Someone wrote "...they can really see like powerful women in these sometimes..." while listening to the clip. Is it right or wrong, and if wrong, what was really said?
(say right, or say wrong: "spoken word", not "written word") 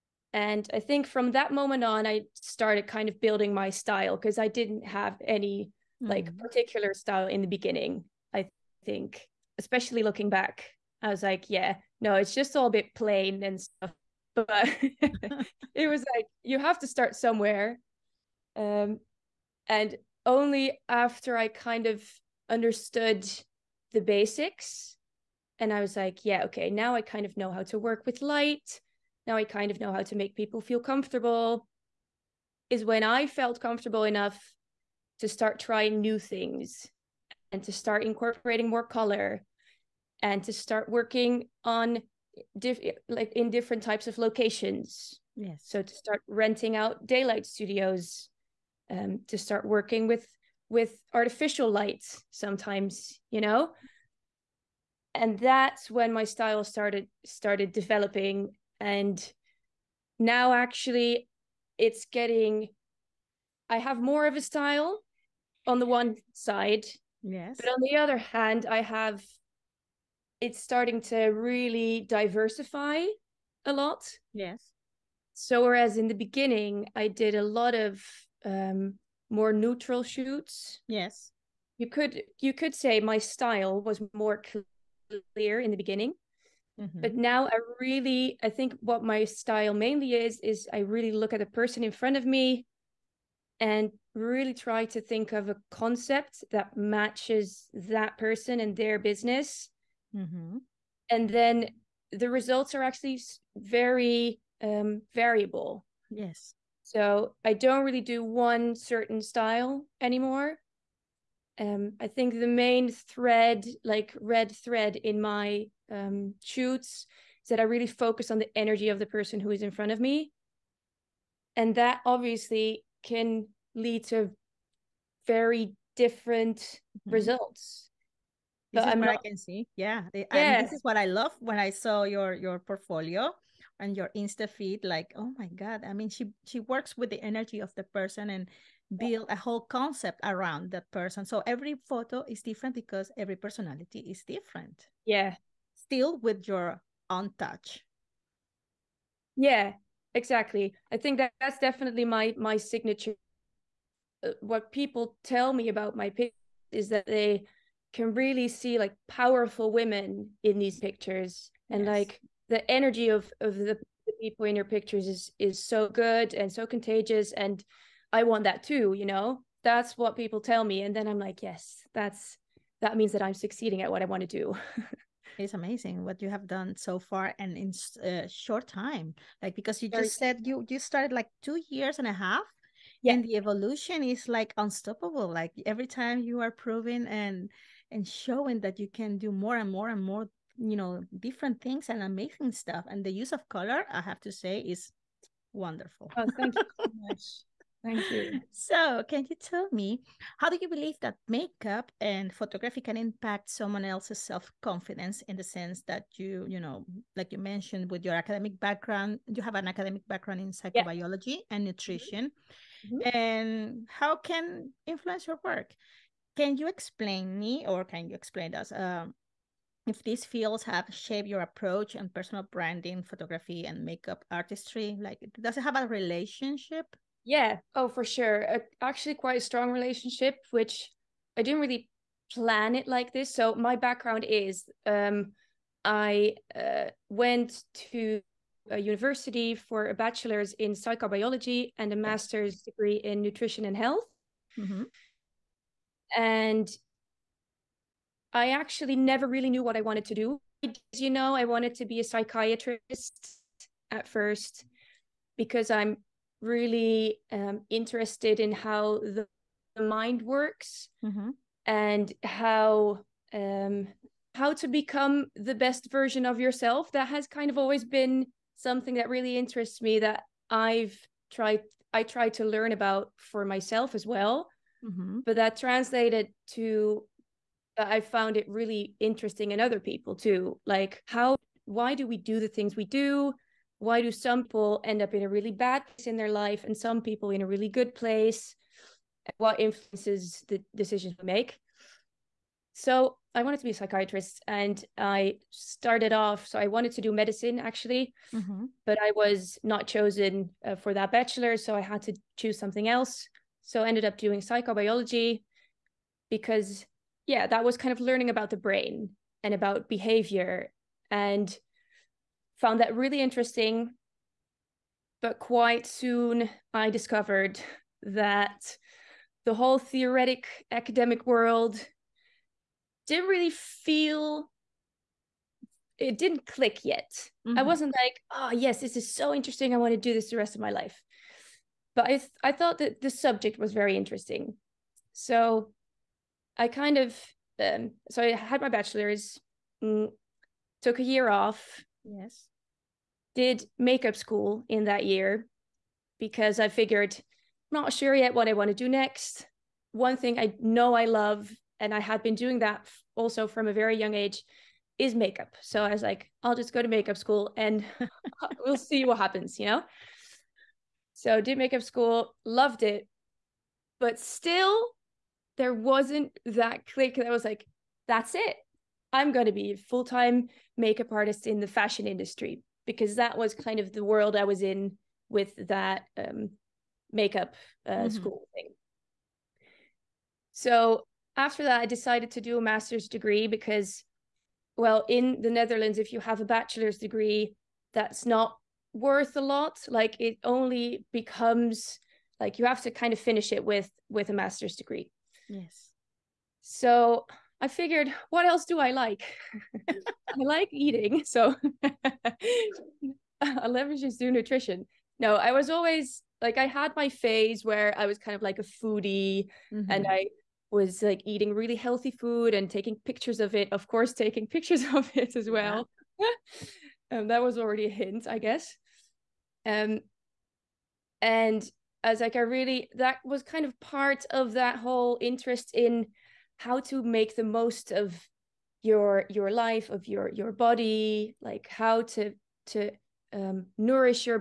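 wrong: "pictures", not "sometimes".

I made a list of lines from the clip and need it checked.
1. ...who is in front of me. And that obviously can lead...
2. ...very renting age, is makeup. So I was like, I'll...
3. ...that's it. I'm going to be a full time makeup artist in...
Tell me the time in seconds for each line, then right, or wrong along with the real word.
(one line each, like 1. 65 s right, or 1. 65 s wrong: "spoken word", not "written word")
1. 119 s right
2. 353 s wrong: "young", not "renting"
3. 368 s right.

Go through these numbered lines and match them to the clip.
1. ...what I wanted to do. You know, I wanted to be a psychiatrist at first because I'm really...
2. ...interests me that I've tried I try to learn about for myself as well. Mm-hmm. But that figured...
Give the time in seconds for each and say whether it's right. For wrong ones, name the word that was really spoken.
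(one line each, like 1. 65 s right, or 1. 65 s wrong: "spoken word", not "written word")
1. 249 s right
2. 269 s wrong: "translated", not "figured".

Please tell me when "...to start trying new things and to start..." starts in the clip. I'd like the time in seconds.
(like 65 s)
35 s.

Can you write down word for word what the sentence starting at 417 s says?
Um, that was already a hint, I guess.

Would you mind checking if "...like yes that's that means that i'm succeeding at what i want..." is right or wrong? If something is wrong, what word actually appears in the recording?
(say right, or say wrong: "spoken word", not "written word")
right.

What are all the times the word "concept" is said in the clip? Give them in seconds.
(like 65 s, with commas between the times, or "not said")
95 s, 139 s.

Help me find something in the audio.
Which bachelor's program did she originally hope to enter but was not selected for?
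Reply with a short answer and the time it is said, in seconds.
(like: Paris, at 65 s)
medicine, at 297 s.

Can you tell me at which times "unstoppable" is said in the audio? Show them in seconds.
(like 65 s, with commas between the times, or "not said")
184 s.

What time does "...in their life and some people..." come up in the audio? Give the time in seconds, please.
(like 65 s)
286 s.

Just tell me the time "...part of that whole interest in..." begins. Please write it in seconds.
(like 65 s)
423 s.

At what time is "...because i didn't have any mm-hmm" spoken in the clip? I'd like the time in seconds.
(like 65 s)
4 s.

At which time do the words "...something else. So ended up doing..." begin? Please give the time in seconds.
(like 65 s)
302 s.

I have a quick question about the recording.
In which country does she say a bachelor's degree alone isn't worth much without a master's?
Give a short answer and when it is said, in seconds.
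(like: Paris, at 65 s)
the Netherlands, at 385 s.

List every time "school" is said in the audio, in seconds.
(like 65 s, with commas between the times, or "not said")
344 s, 357 s, 361 s, 378 s.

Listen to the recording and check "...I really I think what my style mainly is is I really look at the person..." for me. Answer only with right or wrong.
right.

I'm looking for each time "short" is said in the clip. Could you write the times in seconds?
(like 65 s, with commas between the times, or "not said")
178 s.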